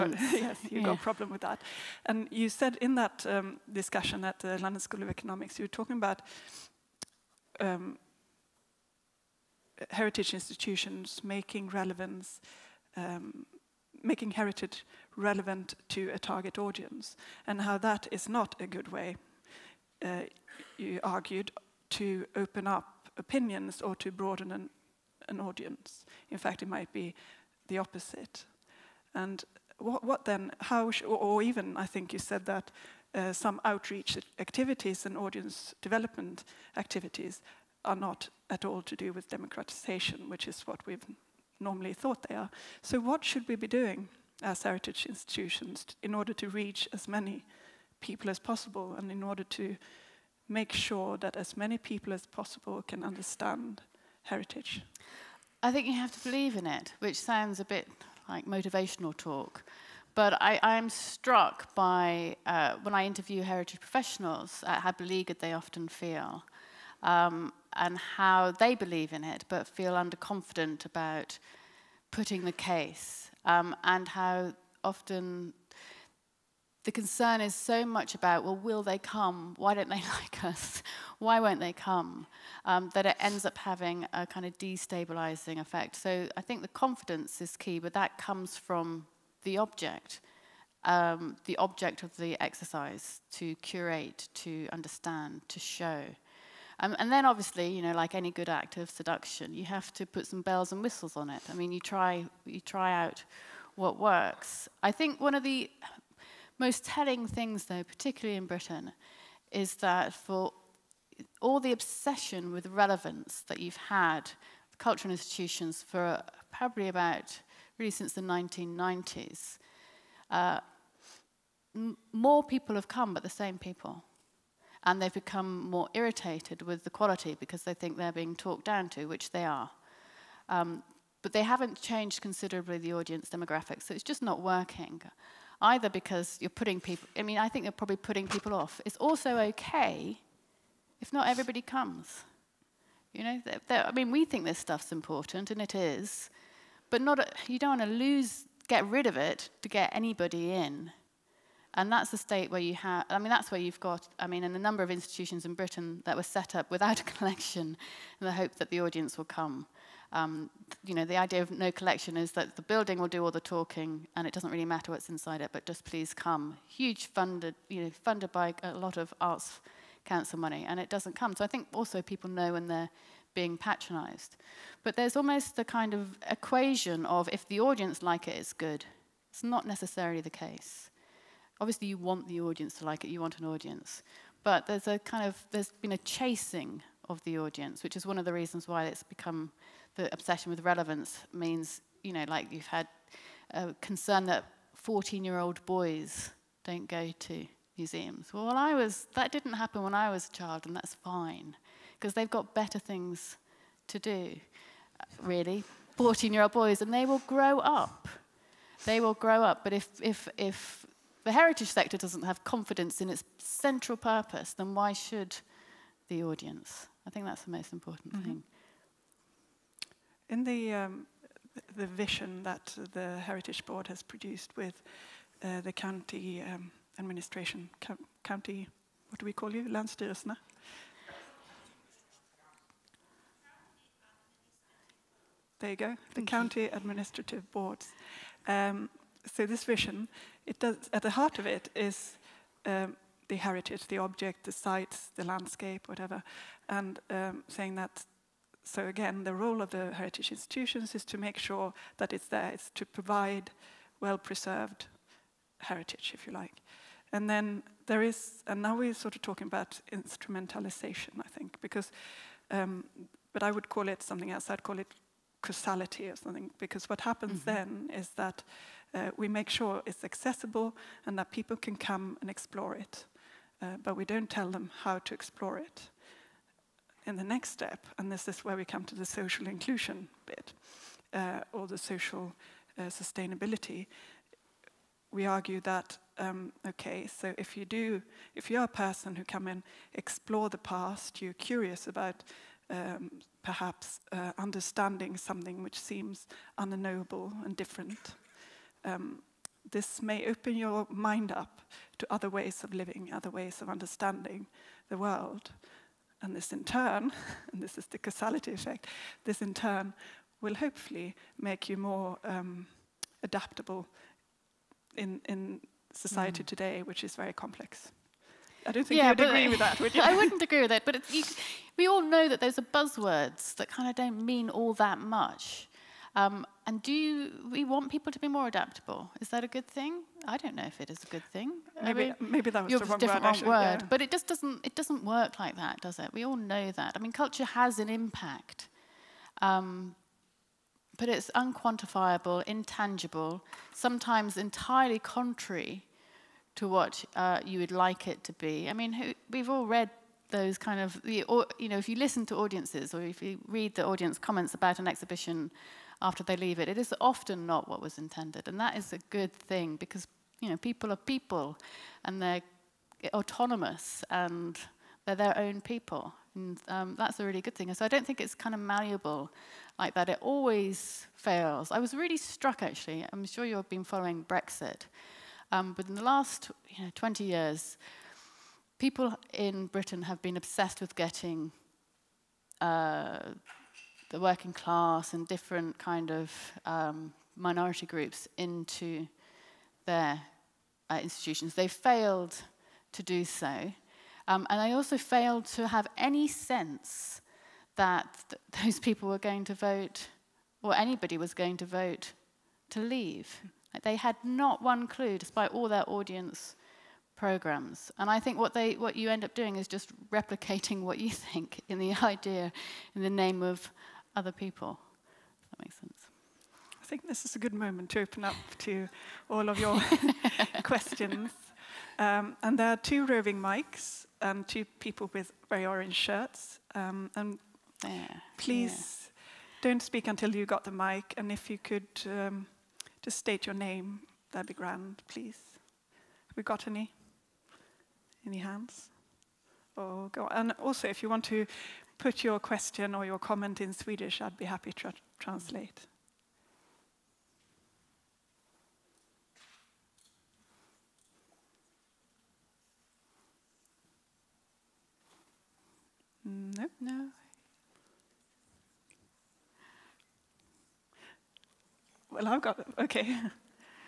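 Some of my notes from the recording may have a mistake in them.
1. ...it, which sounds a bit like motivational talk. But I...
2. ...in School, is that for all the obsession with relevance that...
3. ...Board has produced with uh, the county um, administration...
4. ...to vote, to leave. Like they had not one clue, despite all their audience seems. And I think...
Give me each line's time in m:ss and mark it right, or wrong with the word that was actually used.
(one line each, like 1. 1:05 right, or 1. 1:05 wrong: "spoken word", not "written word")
1. 0:56 right
2. 1:48 wrong: "Britain", not "School"
3. 3:43 right
4. 6:41 wrong: "programs", not "seems".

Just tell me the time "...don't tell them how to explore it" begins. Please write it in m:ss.
4:34.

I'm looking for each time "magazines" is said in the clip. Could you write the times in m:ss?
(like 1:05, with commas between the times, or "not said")
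not said.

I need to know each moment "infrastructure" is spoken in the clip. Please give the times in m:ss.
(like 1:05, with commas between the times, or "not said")
not said.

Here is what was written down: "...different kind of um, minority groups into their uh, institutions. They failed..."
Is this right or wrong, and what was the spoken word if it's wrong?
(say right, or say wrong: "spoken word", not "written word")
right.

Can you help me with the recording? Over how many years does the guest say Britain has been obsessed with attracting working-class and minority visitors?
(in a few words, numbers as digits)
20.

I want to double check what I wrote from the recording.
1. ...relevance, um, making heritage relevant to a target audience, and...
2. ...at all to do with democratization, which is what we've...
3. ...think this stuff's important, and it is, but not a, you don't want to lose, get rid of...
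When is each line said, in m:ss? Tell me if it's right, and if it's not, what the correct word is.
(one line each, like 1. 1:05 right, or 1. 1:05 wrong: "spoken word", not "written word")
1. 0:11 right
2. 0:38 right
3. 2:24 right.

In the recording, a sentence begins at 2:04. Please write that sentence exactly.
And they've become more irritated with the quality because they think they're being talked down to, which they are.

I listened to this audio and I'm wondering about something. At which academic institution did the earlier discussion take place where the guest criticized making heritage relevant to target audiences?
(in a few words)
London School of Economics.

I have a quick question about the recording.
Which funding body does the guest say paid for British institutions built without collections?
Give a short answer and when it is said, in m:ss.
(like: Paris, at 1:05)
Arts Council, at 2:49.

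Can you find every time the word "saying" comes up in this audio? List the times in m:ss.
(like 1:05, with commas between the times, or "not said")
4:07.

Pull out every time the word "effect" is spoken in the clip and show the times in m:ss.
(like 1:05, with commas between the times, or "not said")
1:25, 5:08.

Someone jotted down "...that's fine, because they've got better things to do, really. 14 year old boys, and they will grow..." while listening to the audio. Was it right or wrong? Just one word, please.
right.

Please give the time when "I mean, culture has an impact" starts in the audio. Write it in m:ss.
5:36.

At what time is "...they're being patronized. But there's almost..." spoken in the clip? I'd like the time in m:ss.
2:52.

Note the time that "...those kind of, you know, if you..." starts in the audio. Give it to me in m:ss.
5:50.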